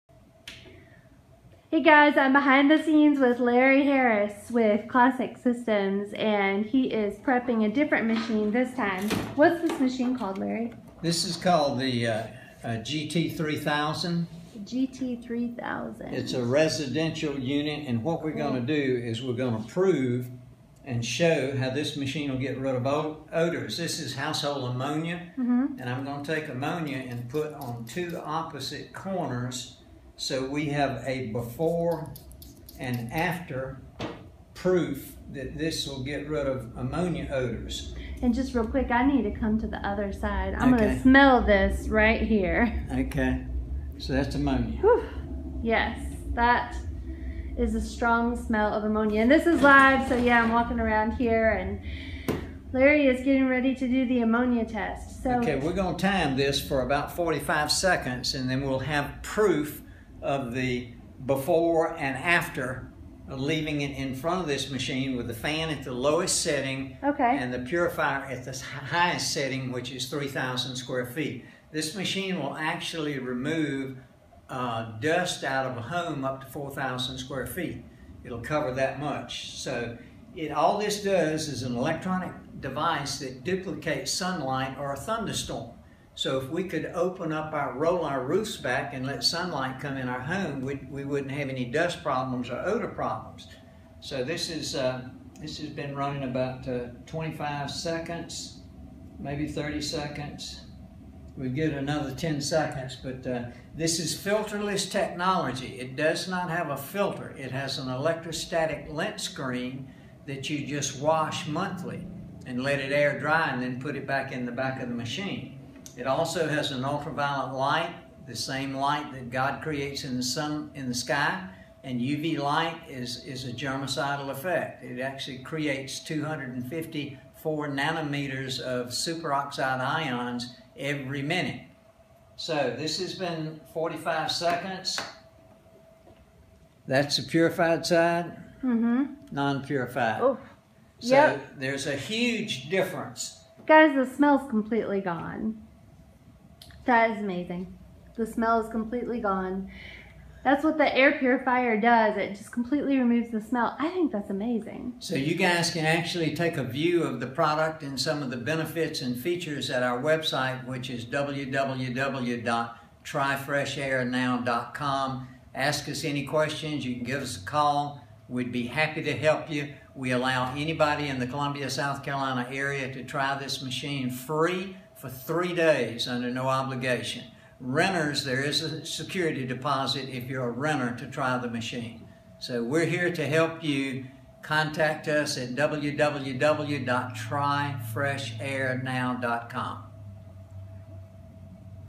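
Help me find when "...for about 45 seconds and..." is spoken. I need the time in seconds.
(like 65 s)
56 s.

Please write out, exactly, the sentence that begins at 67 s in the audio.
and the purifier at the highest setting, which is 3,000 square feet.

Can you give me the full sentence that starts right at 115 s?
It also has an ultraviolet light, the same light that God creates in the sun in the sky.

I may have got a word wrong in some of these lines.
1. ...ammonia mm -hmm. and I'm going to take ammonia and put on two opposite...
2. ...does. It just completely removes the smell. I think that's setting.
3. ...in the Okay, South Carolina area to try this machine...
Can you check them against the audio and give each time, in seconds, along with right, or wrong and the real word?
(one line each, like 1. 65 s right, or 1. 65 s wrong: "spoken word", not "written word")
1. 24 s right
2. 151 s wrong: "amazing", not "setting"
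3. 171 s wrong: "Columbia", not "Okay".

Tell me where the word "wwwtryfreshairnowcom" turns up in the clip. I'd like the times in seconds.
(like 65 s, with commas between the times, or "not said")
161 s, 185 s.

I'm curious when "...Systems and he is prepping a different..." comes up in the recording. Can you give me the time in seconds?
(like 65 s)
5 s.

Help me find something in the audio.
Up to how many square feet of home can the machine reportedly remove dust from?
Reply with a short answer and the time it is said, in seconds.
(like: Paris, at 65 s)
4,000 square feet, at 76 s.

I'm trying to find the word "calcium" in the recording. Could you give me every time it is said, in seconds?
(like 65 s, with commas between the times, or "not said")
not said.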